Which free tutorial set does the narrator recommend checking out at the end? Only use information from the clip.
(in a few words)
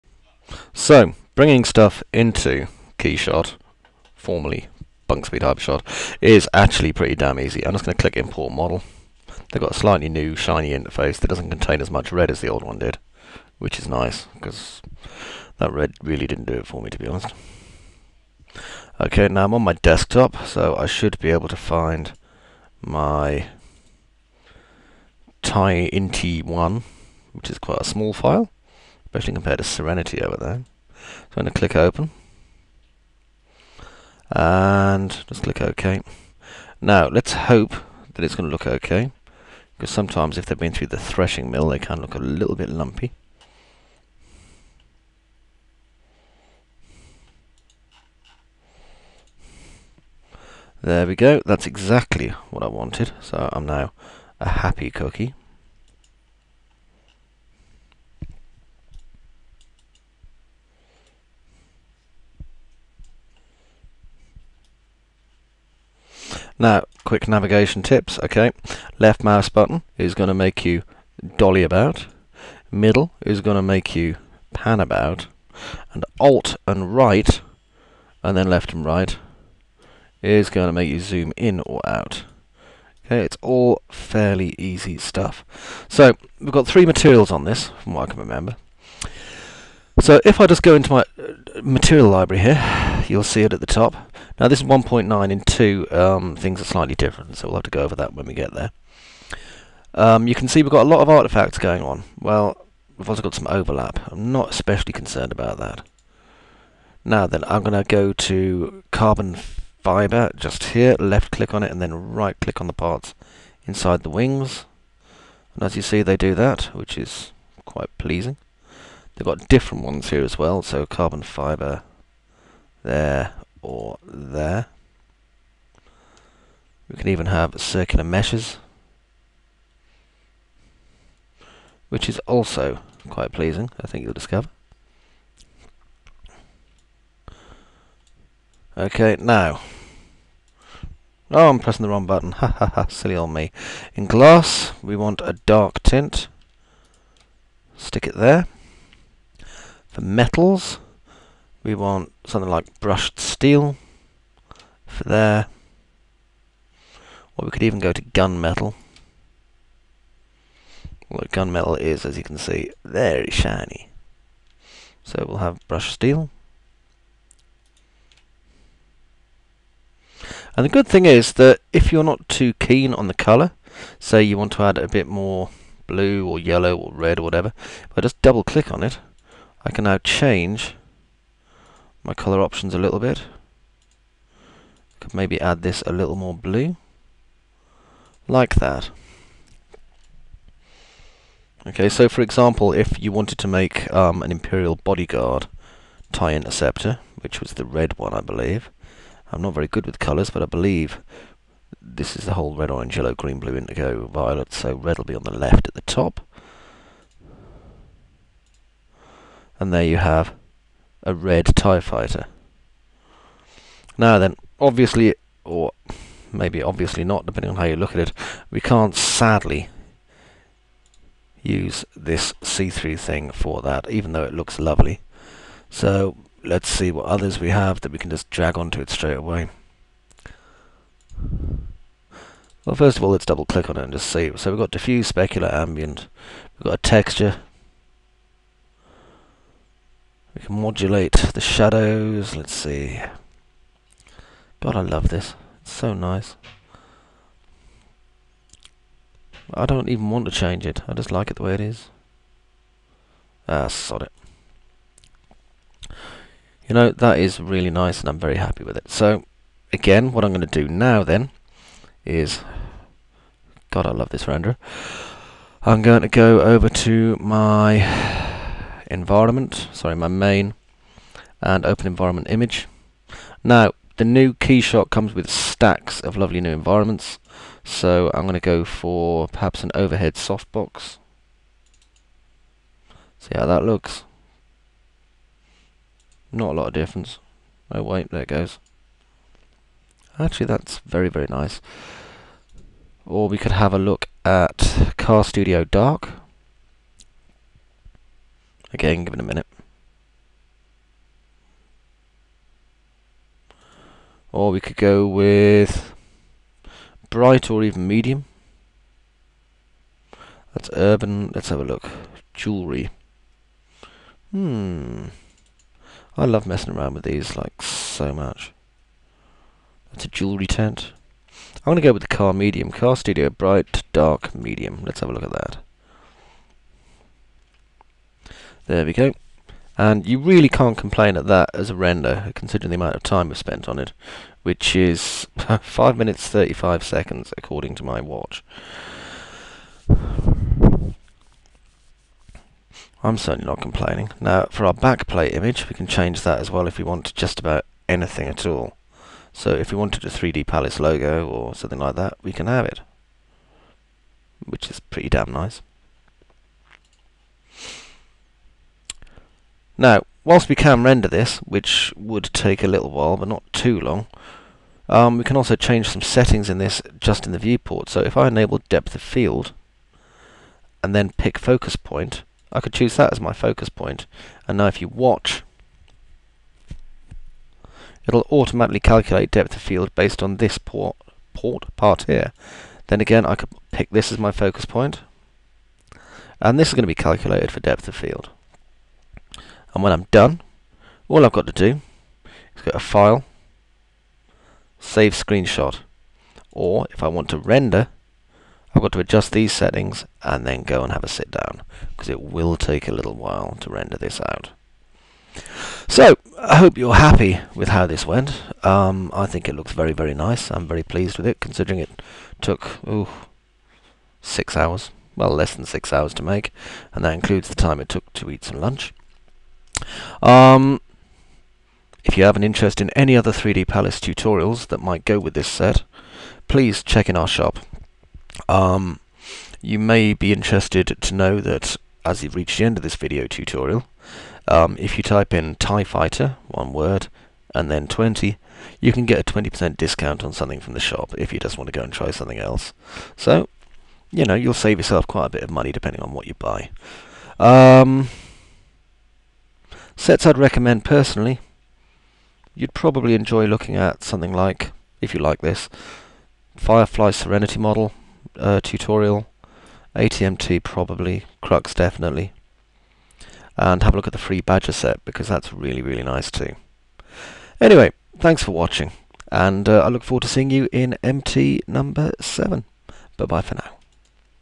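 Badger set.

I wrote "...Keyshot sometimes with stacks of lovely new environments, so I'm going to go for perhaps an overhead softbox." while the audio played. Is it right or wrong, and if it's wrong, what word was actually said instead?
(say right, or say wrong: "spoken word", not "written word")
wrong: "comes", not "sometimes".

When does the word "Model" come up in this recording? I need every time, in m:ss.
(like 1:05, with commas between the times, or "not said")
0:08, 7:37.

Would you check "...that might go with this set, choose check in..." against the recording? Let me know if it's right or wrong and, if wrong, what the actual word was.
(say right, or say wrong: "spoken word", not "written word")
wrong: "please", not "choose".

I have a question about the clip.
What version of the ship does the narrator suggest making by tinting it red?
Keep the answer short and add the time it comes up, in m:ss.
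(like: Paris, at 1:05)
Imperial Bodyguard TIE Interceptor, at 3:14.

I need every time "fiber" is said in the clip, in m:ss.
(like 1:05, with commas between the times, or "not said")
1:49, 2:01.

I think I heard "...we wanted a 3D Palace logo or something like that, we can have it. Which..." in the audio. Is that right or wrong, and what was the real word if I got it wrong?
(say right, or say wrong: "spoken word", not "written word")
right.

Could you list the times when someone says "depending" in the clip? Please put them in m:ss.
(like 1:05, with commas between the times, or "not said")
3:37, 7:25.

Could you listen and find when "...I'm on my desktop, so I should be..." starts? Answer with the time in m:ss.
0:19.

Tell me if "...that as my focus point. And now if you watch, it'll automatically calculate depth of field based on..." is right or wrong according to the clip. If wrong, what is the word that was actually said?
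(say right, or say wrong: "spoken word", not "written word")
right.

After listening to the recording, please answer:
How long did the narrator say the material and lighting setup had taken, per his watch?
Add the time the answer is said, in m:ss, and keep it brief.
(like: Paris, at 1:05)
5 minutes 35 seconds, at 5:35.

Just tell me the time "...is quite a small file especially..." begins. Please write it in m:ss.
0:27.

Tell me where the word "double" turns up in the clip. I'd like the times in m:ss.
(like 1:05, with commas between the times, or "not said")
2:58, 3:53.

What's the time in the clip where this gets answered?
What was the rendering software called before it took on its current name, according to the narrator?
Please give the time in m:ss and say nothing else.
0:05.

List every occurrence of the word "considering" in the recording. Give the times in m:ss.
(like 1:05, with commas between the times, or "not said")
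5:32, 6:51.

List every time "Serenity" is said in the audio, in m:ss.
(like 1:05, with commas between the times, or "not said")
0:29, 7:37.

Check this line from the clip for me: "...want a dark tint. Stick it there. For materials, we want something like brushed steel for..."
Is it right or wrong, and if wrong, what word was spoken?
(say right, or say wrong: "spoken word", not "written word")
wrong: "metals", not "materials".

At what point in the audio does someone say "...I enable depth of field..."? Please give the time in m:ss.
6:08.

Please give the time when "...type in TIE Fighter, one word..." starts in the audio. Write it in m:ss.
7:15.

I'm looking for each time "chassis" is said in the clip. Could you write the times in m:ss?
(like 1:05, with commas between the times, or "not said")
not said.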